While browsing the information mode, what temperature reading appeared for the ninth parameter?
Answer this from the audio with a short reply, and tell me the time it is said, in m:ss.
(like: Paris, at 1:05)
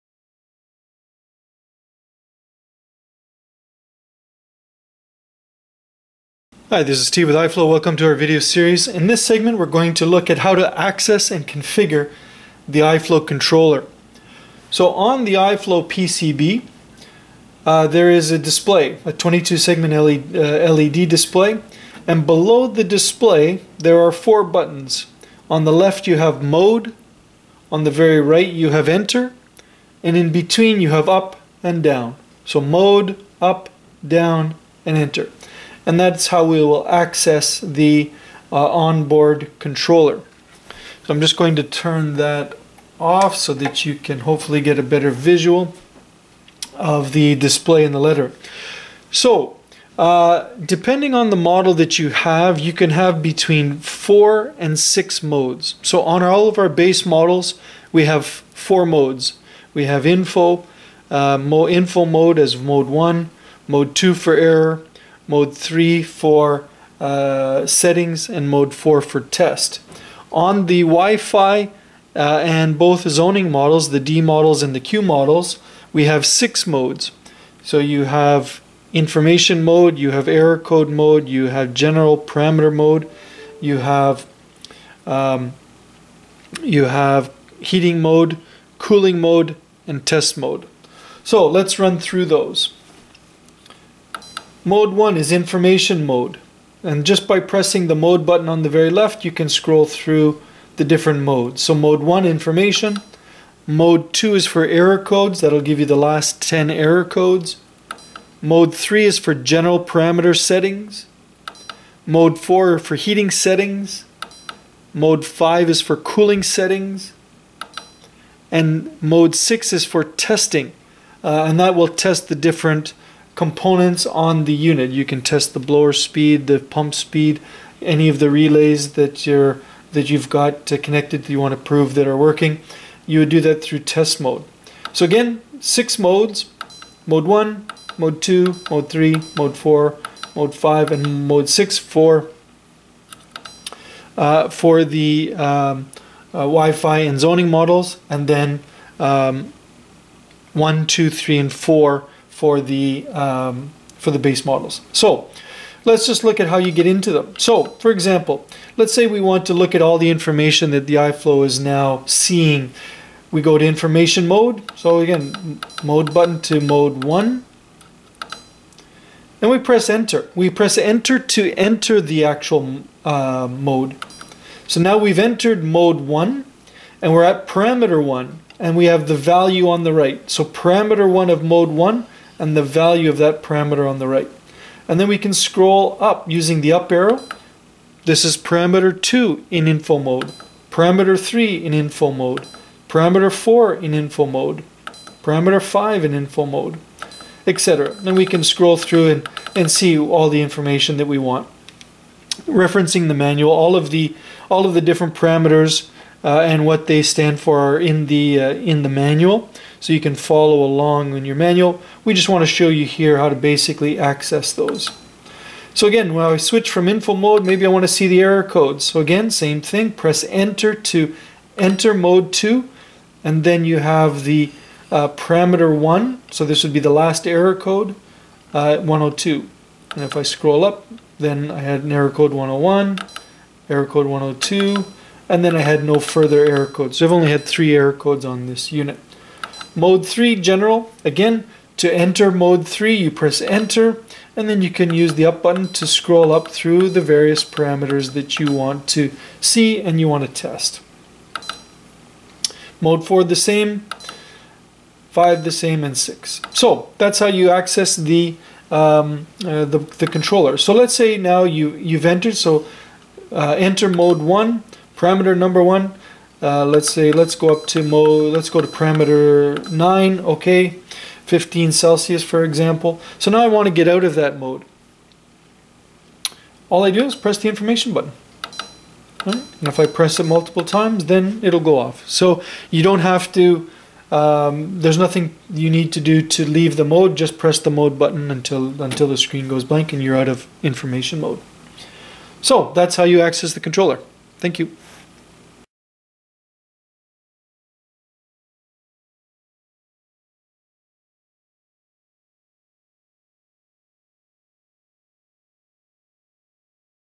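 15 Celsius, at 4:31.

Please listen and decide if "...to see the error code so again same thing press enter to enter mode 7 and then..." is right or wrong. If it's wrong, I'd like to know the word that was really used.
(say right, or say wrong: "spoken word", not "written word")
wrong: "2", not "7".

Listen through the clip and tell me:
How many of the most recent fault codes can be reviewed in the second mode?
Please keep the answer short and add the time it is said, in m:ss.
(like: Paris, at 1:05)
10, at 1:45.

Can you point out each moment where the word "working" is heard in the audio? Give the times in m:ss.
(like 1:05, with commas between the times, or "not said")
2:12.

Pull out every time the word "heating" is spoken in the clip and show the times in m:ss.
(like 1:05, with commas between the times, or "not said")
1:27, 1:52.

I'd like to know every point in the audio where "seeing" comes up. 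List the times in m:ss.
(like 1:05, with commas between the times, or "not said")
2:42.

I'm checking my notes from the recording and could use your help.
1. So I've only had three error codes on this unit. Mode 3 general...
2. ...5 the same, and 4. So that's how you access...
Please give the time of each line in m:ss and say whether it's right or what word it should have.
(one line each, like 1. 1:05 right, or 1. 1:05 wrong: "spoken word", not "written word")
1. 3:56 right
2. 4:15 wrong: "6", not "4".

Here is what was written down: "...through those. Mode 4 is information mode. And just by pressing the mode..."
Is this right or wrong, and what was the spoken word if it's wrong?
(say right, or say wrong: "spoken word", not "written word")
wrong: "1", not "4".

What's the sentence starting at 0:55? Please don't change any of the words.
So on all of our base models, we have four modes.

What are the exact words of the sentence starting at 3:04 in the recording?
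And then we can scroll up using the up arrow.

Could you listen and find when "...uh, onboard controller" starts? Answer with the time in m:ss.
0:38.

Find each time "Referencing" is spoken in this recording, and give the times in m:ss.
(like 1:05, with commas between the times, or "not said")
3:22.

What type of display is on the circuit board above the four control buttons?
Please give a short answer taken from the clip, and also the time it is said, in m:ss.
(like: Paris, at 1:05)
22-segment LED display, at 0:19.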